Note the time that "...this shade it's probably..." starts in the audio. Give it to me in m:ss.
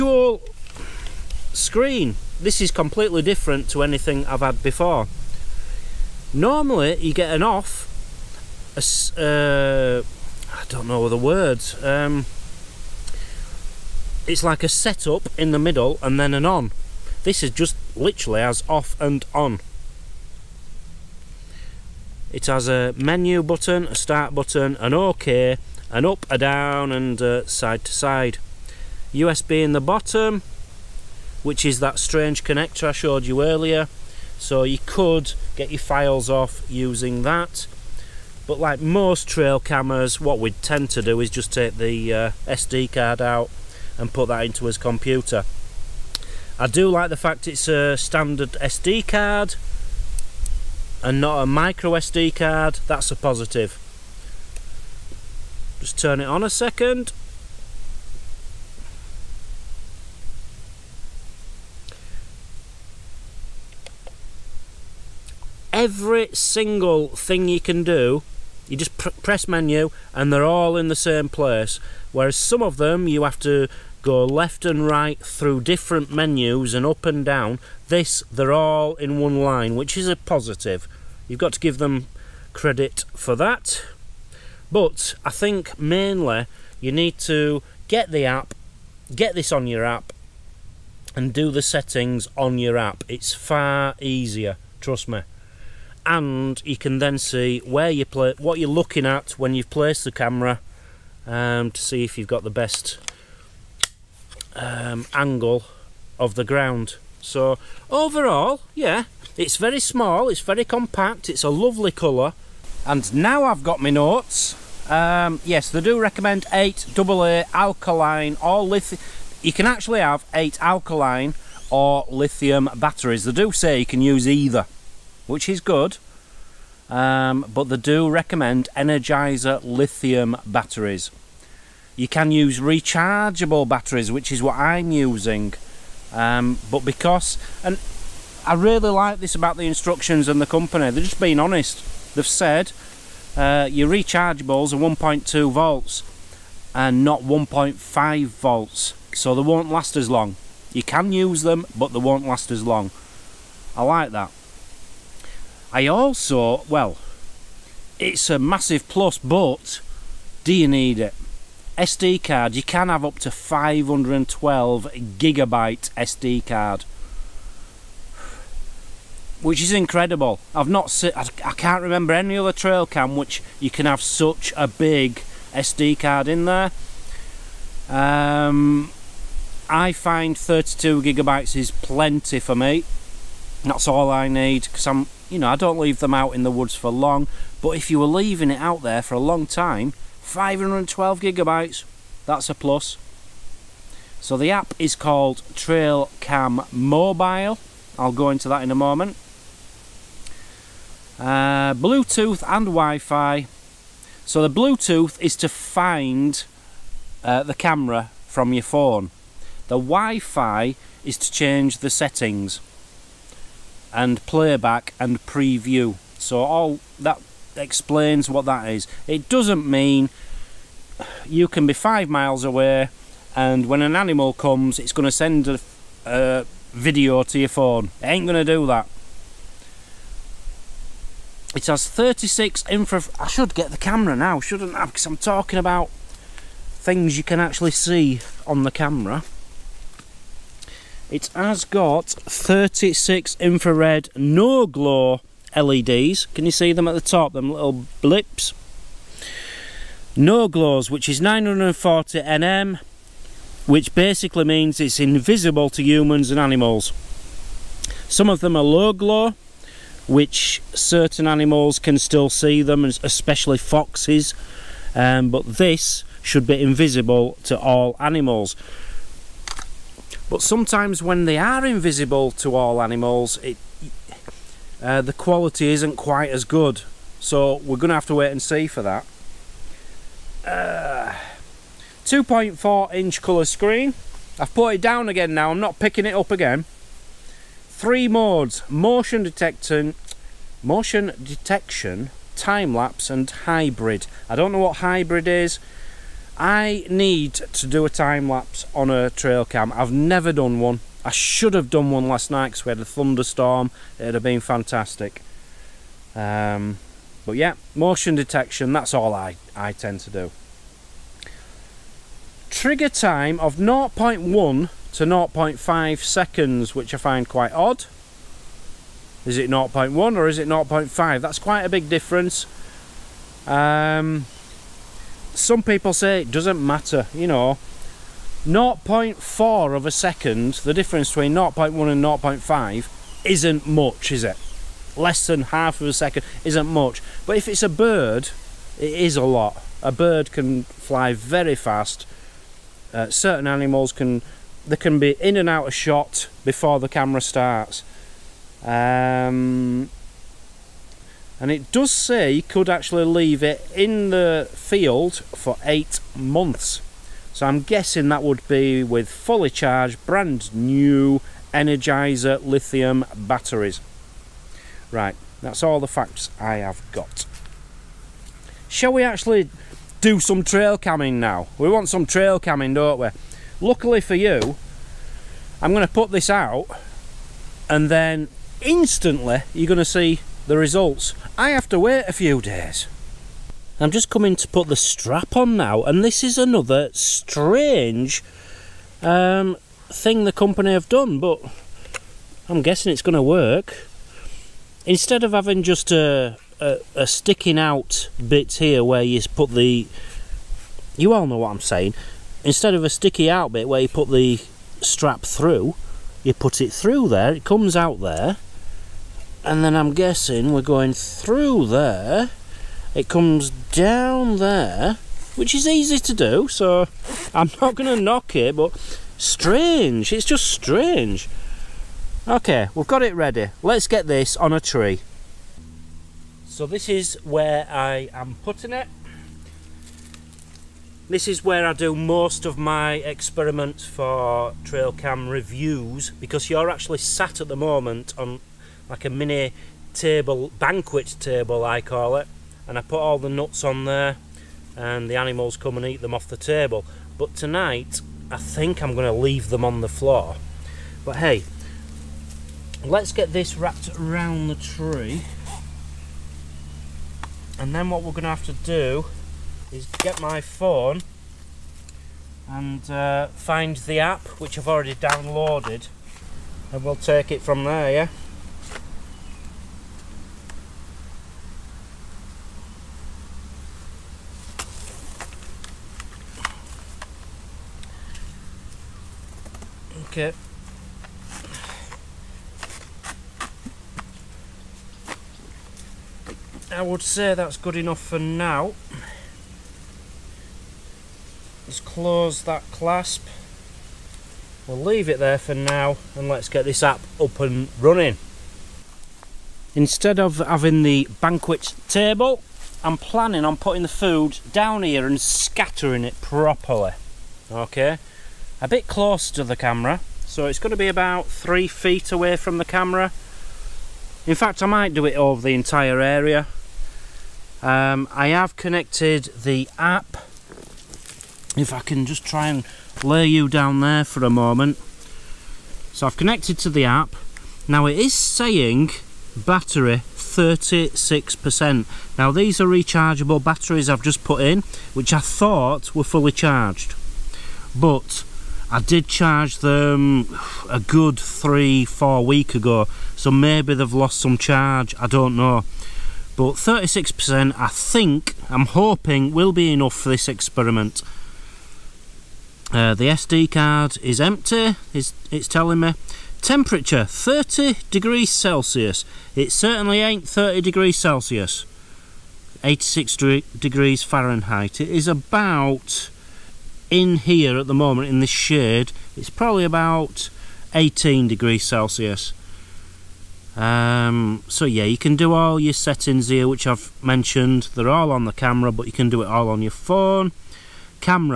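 9:28.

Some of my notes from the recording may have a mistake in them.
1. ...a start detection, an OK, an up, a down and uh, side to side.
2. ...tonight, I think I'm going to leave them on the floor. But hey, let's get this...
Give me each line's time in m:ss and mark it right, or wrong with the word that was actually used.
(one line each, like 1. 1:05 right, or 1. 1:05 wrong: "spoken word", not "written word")
1. 0:23 wrong: "button", not "detection"
2. 7:27 right.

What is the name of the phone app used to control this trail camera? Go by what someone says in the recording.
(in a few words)
Trailcam Mobile.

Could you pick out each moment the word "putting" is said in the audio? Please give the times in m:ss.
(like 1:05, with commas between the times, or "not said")
7:08, 8:23.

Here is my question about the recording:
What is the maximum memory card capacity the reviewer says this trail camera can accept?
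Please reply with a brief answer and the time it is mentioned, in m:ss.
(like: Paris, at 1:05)
512 gigabytes, at 2:43.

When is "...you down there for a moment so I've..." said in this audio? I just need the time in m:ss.
8:43.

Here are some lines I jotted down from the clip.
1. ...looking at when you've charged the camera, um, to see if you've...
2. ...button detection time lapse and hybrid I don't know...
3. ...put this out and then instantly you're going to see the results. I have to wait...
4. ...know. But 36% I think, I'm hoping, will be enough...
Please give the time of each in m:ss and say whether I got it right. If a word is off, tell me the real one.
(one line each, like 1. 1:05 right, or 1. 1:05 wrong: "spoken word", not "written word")
1. 1:38 wrong: "placed", not "charged"
2. 4:50 wrong: "motion", not "button"
3. 6:15 right
4. 9:05 right.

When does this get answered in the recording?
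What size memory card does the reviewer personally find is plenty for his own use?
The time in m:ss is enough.
3:00.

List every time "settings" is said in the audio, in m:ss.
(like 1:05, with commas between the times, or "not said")
1:31, 3:31, 9:35.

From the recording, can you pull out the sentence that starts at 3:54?
Because I'm talking about things you can actually see on the camera.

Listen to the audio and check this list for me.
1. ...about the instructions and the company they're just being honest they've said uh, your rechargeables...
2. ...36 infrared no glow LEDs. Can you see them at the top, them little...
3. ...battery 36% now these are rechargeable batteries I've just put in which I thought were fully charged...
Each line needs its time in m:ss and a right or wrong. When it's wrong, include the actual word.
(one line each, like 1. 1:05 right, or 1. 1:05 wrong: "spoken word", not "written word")
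1. 2:19 right
2. 4:02 right
3. 8:49 right.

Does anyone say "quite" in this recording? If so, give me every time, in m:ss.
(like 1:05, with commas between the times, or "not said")
4:35, 5:17, 5:21.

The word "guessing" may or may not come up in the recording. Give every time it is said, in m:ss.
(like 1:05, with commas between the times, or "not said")
5:57, 6:32, 6:49.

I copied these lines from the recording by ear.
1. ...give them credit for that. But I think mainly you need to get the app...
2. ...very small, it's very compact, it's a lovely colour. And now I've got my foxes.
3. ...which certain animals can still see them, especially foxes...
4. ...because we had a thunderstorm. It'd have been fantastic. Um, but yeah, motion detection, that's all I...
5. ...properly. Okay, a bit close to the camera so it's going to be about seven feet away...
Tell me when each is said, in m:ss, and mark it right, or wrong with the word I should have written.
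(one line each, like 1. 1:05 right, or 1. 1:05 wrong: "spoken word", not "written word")
1. 1:21 right
2. 1:49 wrong: "notes", not "foxes"
3. 4:20 right
4. 5:02 right
5. 8:26 wrong: "three", not "seven".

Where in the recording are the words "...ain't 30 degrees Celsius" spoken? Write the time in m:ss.
9:19.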